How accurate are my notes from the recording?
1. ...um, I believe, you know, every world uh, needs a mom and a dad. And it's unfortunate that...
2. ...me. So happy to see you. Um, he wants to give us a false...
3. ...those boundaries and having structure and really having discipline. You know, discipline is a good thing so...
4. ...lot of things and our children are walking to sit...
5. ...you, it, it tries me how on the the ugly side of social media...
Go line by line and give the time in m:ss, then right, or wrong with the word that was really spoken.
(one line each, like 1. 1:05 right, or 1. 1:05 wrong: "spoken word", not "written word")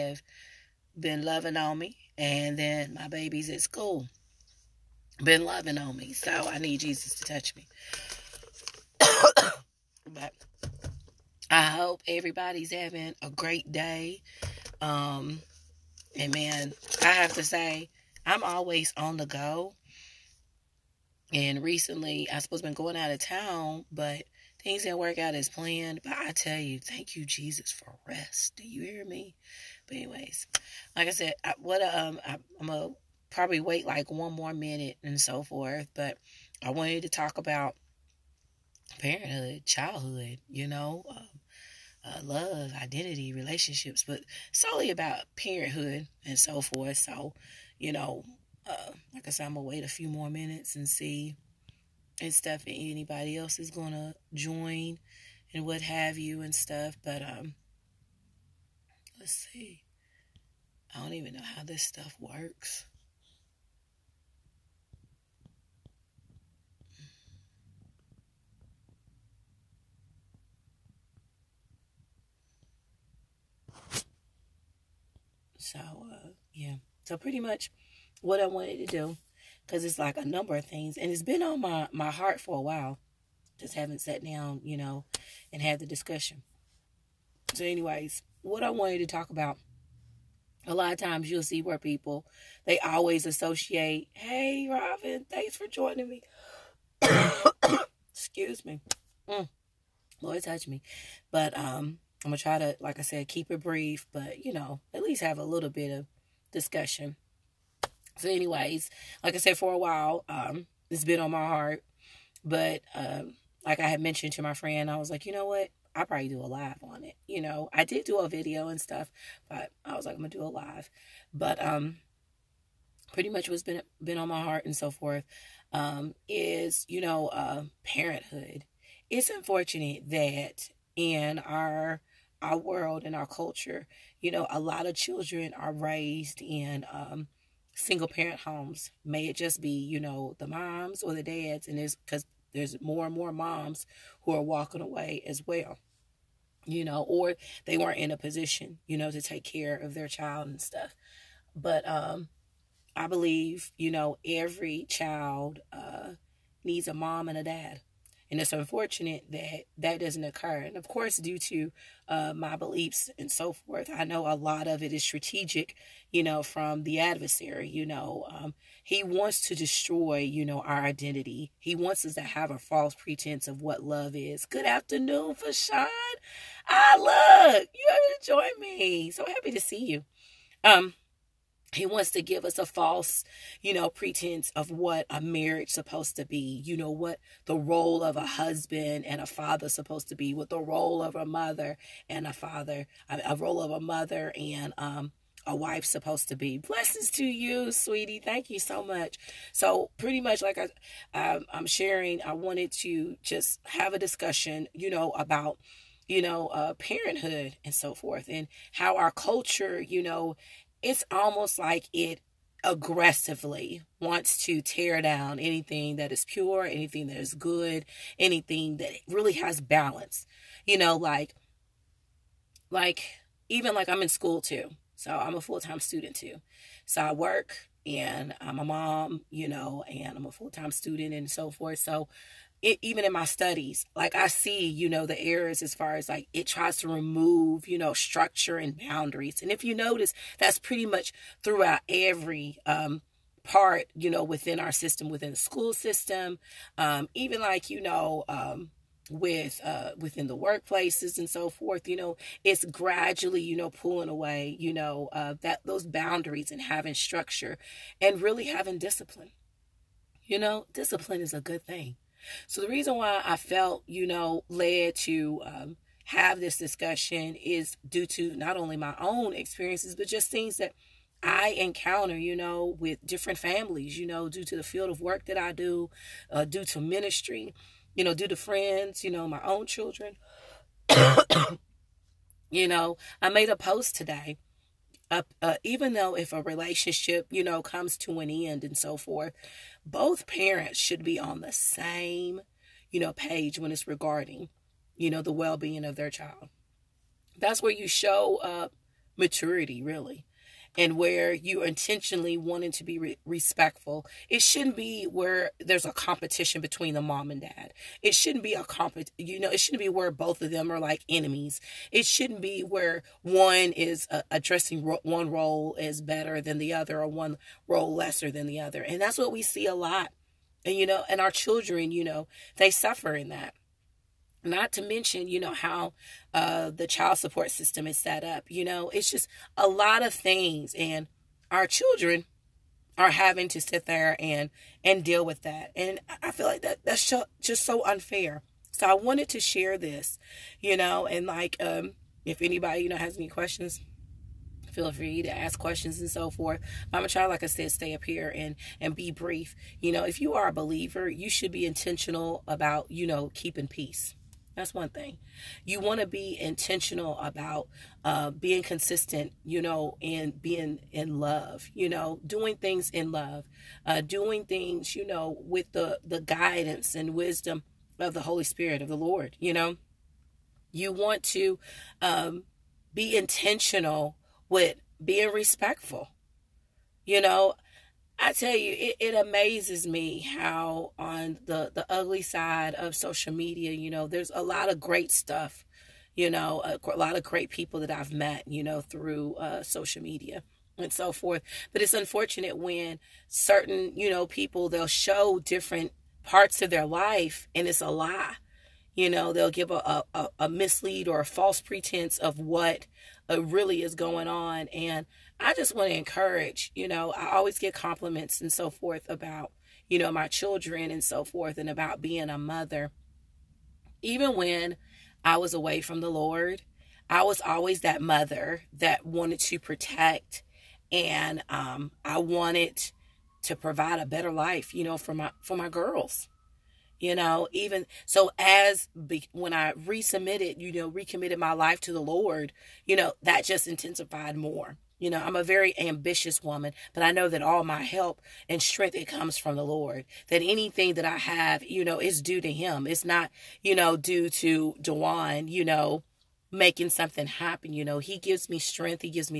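1. 2:31 wrong: "child", not "world"
2. 2:58 right
3. 4:15 right
4. 5:29 wrong: "having", not "walking"
5. 6:18 wrong: "amazes", not "tries".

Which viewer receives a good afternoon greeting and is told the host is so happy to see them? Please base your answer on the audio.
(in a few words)
Fashawn.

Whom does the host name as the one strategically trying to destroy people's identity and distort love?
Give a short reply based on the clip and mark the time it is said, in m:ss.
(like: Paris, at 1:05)
The adversary, at 2:46.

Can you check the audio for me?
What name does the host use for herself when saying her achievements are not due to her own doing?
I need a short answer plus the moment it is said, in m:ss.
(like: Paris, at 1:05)
Dwan, at 7:24.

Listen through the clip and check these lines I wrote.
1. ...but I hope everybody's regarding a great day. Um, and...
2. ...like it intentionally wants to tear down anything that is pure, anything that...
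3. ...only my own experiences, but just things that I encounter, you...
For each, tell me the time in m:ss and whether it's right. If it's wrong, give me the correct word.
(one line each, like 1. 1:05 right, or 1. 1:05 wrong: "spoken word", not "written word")
1. 0:10 wrong: "having", not "regarding"
2. 3:31 wrong: "aggressively", not "intentionally"
3. 4:28 right.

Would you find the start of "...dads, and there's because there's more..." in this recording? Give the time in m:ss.
2:21.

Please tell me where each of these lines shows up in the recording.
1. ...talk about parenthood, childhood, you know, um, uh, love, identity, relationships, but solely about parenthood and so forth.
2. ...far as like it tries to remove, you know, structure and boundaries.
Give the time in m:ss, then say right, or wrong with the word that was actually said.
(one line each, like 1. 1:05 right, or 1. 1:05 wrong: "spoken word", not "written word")
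1. 0:37 right
2. 3:55 right.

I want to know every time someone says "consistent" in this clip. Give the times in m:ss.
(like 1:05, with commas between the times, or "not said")
5:58.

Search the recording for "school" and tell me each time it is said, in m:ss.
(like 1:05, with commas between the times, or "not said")
0:03, 3:44, 4:05.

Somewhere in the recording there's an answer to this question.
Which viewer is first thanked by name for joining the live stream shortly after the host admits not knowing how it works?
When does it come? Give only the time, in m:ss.
1:34.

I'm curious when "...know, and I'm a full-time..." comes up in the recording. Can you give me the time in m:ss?
3:49.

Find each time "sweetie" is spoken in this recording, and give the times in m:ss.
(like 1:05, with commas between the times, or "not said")
3:17.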